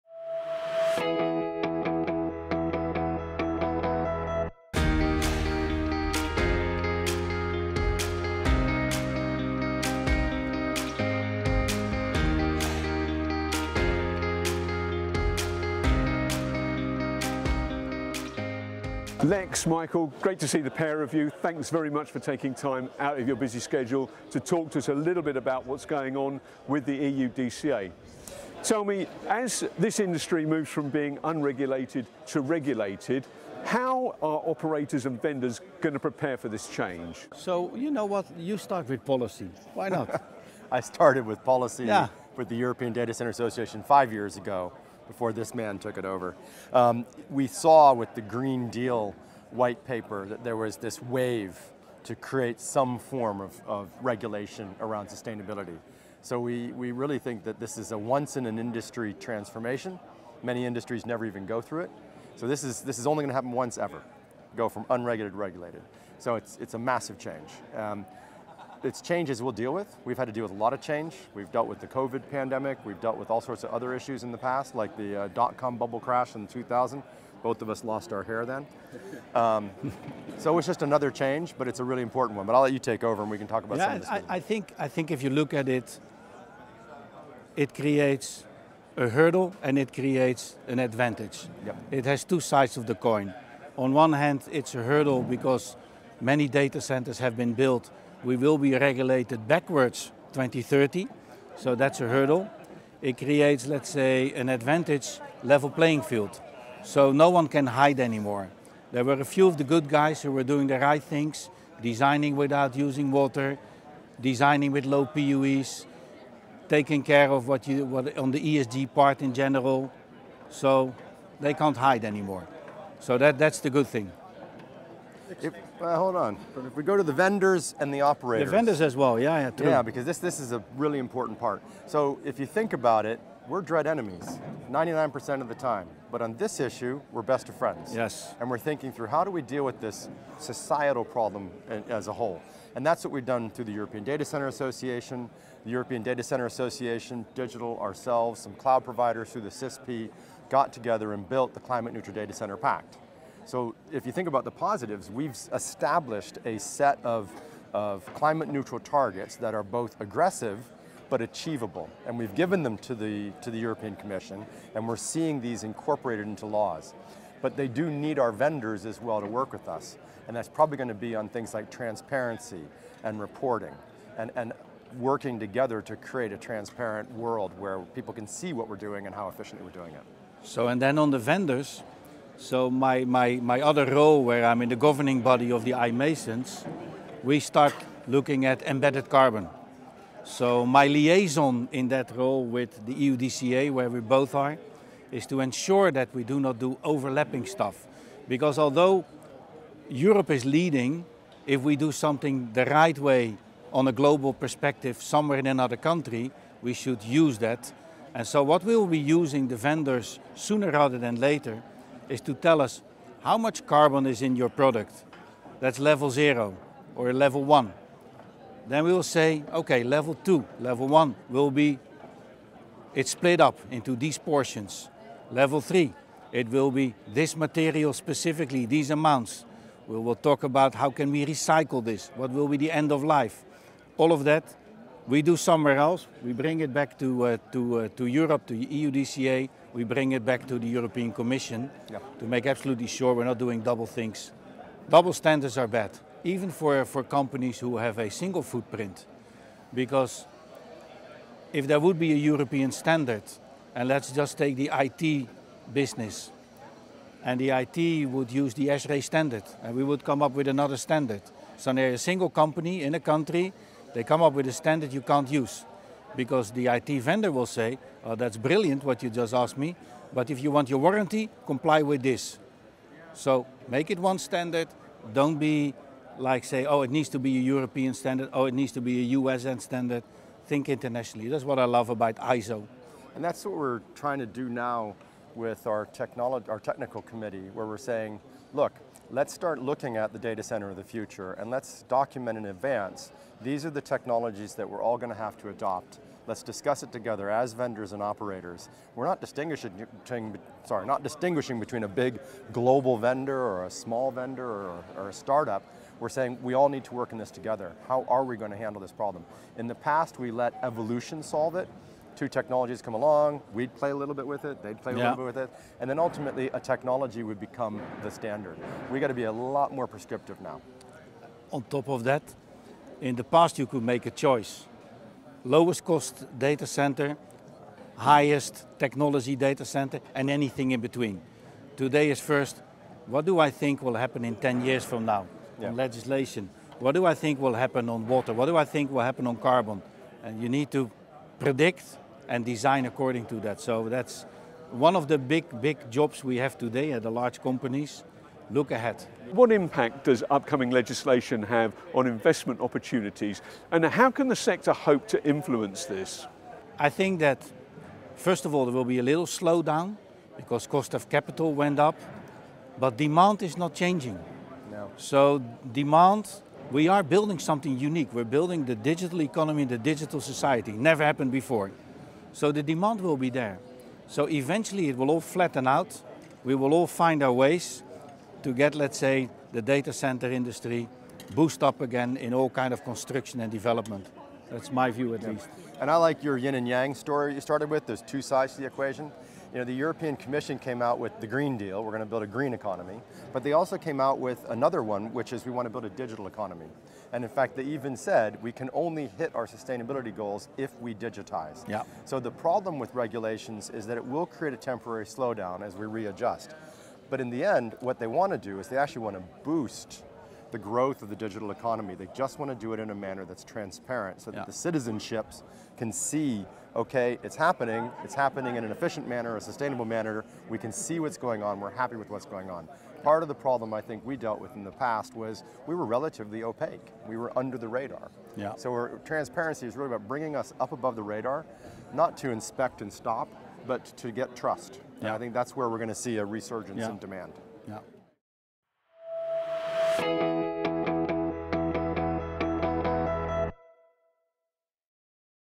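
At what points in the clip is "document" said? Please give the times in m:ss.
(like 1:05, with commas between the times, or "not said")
4:51.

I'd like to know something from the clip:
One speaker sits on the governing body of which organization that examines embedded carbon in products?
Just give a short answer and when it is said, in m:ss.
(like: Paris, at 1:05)
iMasons, at 3:05.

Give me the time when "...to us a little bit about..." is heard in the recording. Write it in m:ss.
0:24.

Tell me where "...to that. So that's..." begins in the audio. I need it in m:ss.
5:43.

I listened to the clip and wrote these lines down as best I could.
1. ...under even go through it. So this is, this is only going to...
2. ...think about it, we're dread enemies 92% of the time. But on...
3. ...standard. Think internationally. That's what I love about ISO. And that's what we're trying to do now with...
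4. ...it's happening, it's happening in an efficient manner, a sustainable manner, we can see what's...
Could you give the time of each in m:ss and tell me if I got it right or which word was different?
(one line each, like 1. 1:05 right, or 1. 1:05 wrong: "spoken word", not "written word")
1. 1:01 wrong: "never", not "under"
2. 2:12 wrong: "99", not "92"
3. 4:39 right
4. 6:57 right.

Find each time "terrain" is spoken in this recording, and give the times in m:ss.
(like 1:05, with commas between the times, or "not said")
not said.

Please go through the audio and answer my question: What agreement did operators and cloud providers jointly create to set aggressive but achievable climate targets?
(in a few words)
Climate Neutral Data Center Pact.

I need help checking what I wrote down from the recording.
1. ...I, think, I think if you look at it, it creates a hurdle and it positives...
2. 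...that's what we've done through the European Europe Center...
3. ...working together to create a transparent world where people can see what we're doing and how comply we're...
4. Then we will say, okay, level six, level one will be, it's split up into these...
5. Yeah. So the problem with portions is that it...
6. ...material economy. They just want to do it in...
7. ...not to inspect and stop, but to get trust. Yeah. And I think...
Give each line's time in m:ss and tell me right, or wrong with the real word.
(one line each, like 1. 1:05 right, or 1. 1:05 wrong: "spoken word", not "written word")
1. 1:24 wrong: "creates", not "positives"
2. 2:22 wrong: "Data", not "Europe"
3. 2:54 wrong: "efficiently", not "comply"
4. 3:38 wrong: "two", not "six"
5. 6:41 wrong: "regulations", not "portions"
6. 6:51 wrong: "digital", not "material"
7. 7:11 right.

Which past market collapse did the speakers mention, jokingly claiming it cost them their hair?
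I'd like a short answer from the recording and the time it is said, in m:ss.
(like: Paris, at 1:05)
dot-com bubble crash, at 1:15.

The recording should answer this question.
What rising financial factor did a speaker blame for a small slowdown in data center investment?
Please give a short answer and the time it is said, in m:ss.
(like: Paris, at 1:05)
cost of capital, at 6:00.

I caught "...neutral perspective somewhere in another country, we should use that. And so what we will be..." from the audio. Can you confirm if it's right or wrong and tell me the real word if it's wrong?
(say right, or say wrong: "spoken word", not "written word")
wrong: "global", not "neutral".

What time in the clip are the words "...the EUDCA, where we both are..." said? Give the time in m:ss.
3:12.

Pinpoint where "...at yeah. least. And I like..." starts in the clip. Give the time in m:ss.
6:25.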